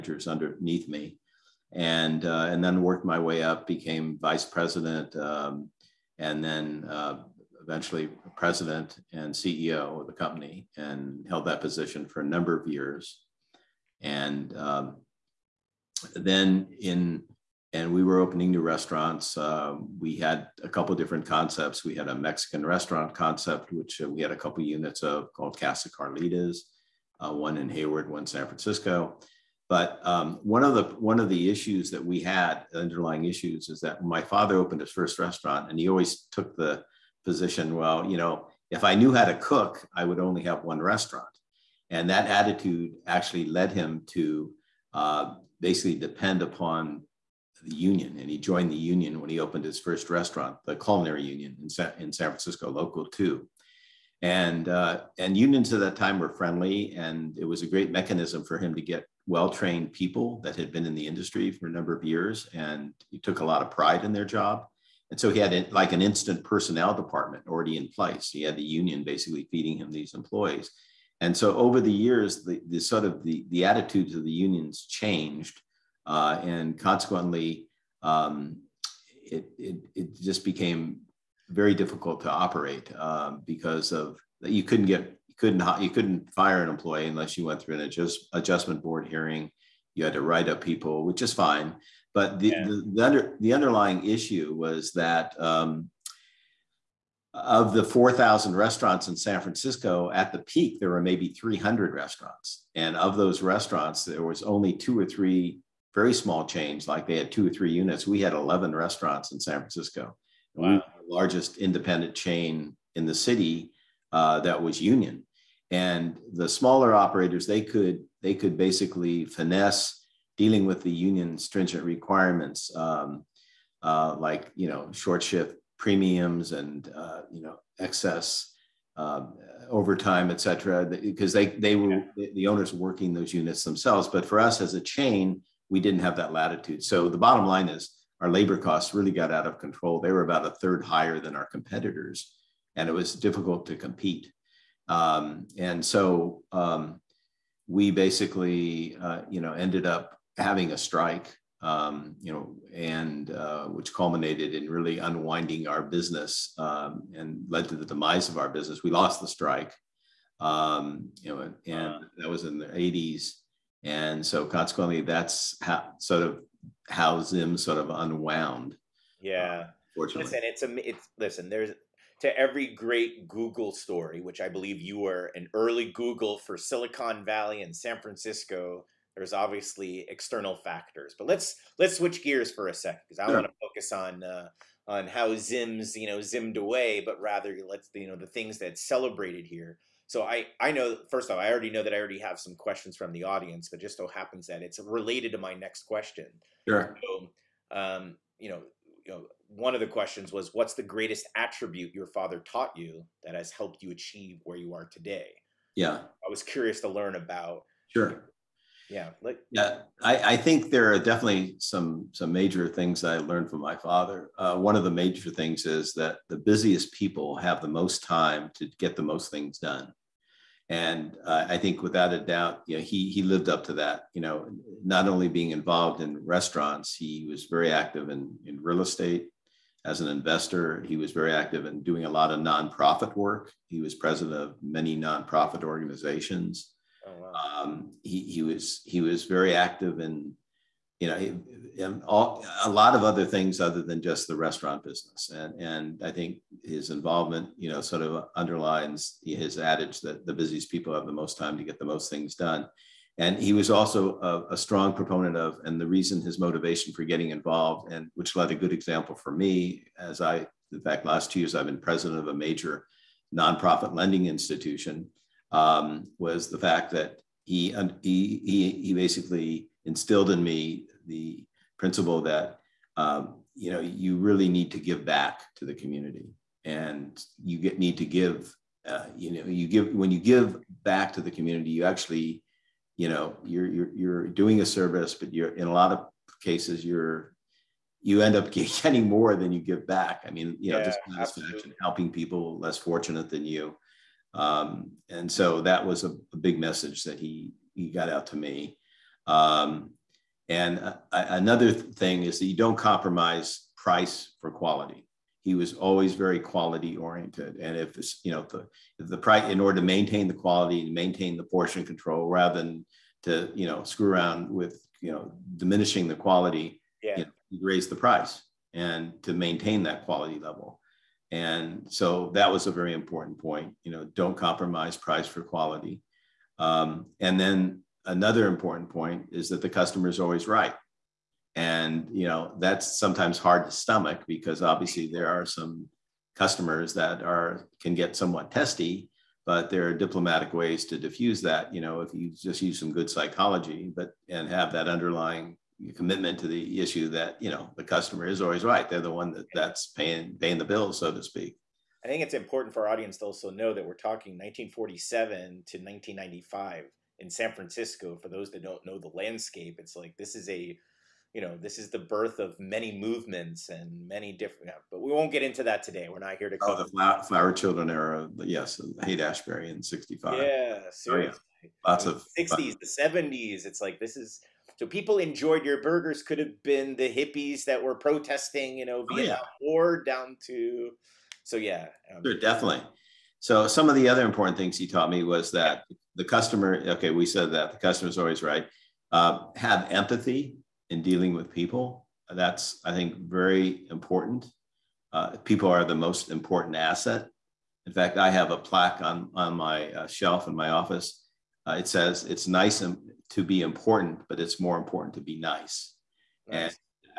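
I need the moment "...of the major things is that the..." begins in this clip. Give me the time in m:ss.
3:34.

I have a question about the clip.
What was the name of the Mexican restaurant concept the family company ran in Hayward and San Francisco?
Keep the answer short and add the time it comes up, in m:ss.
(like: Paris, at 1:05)
Casa Carlitas, at 0:25.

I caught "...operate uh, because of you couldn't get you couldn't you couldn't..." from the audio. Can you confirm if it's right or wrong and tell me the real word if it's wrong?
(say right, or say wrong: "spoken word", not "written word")
right.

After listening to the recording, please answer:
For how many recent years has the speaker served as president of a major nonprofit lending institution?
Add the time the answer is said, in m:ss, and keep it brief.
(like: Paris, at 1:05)
2, at 4:21.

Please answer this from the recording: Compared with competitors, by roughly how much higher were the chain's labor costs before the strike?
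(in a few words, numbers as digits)
a third.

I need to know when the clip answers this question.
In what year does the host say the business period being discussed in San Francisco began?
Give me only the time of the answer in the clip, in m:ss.
5:54.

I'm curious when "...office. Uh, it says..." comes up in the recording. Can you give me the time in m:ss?
6:40.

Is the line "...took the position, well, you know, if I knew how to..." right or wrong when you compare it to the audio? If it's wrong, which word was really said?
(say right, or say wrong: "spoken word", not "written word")
right.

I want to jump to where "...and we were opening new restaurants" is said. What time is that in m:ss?
0:17.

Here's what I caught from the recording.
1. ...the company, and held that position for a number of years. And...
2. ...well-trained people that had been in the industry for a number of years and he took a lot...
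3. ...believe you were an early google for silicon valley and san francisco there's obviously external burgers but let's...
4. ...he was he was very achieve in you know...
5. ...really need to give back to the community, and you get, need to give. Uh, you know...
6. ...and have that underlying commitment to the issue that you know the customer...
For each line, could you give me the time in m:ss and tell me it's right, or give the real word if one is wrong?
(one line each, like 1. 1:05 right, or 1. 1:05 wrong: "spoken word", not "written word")
1. 0:10 right
2. 0:59 right
3. 2:54 wrong: "factors", not "burgers"
4. 3:58 wrong: "active", not "achieve"
5. 4:34 right
6. 5:44 right.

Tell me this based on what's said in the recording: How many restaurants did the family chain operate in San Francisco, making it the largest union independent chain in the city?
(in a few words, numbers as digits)
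11.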